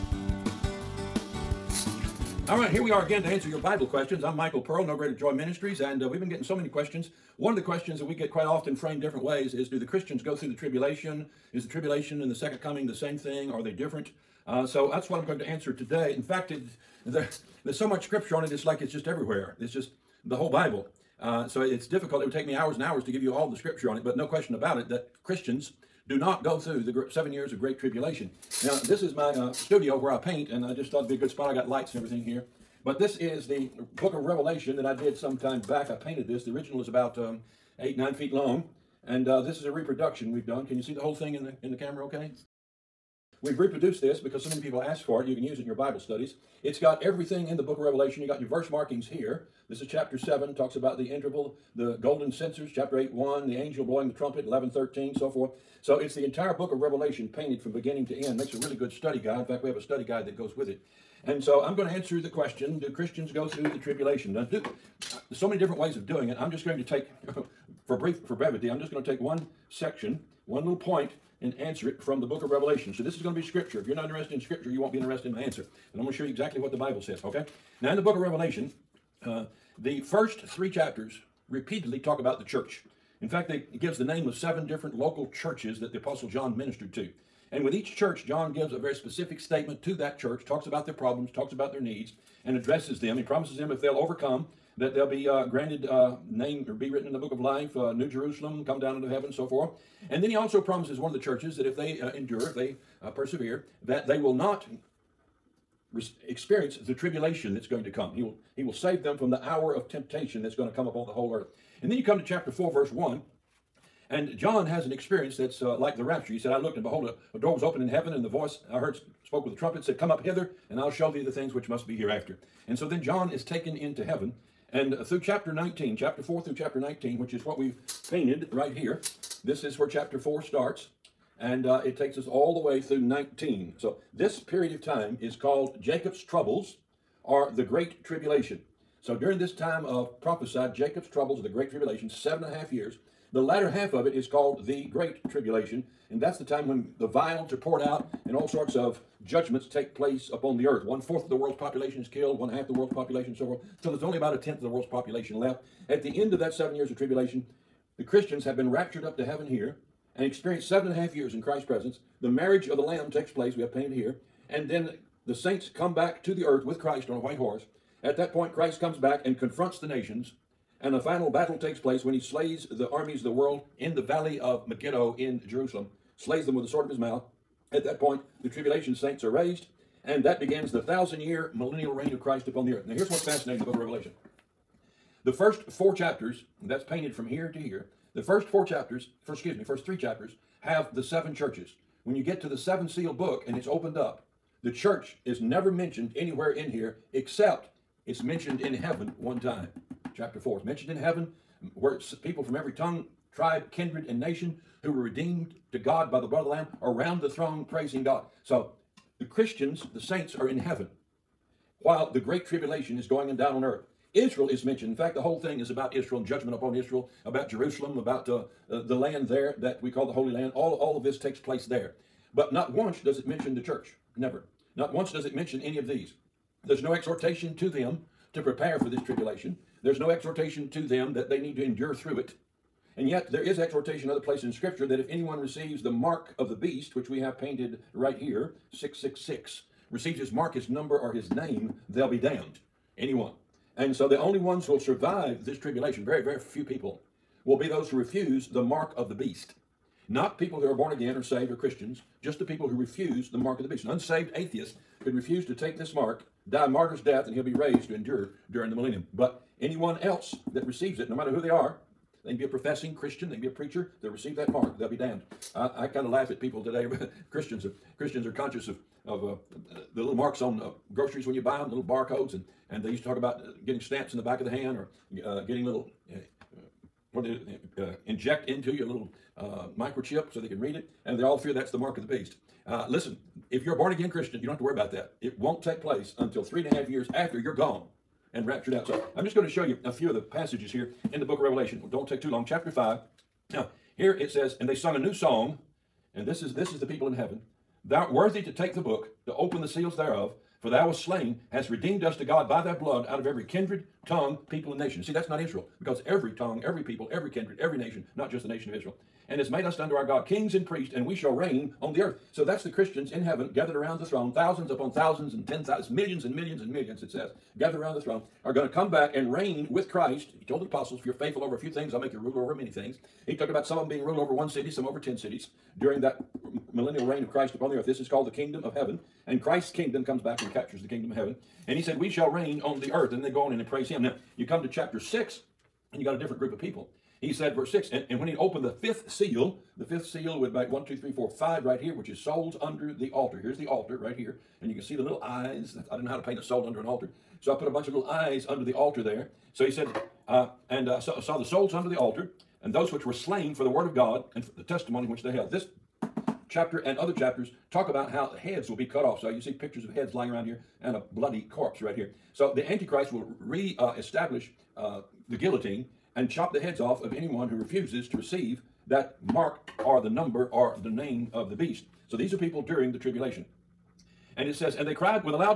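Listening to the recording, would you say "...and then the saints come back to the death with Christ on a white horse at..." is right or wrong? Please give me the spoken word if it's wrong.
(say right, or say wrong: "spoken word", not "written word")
wrong: "earth", not "death".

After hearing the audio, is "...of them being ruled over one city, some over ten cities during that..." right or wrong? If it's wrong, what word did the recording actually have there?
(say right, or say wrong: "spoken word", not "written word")
right.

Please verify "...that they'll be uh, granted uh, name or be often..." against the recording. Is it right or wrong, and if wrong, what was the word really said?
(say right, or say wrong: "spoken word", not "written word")
wrong: "written", not "often".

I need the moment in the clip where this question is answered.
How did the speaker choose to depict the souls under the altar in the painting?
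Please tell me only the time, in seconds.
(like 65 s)
347 s.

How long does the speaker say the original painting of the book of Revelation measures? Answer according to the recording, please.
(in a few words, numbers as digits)
8 or 9 feet long.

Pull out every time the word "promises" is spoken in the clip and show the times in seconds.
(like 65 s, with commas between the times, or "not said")
93 s, 100 s.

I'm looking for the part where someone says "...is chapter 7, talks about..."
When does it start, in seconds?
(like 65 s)
49 s.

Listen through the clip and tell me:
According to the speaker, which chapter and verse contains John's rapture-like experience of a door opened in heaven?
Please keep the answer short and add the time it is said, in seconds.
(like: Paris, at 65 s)
Chapter 4, verse 1, at 112 s.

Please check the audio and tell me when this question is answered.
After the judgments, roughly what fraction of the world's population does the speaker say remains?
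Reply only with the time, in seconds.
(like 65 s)
154 s.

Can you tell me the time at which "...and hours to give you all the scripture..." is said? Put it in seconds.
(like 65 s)
22 s.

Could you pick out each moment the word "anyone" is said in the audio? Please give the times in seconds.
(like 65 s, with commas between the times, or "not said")
235 s, 242 s, 259 s, 367 s.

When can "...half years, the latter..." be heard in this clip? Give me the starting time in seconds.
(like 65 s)
142 s.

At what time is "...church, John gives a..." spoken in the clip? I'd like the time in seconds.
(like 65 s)
87 s.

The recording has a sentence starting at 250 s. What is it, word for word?
Not people who are born again or saved or Christians, just the people who refuse the mark of the beast.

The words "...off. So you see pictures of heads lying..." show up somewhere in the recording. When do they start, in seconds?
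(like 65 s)
359 s.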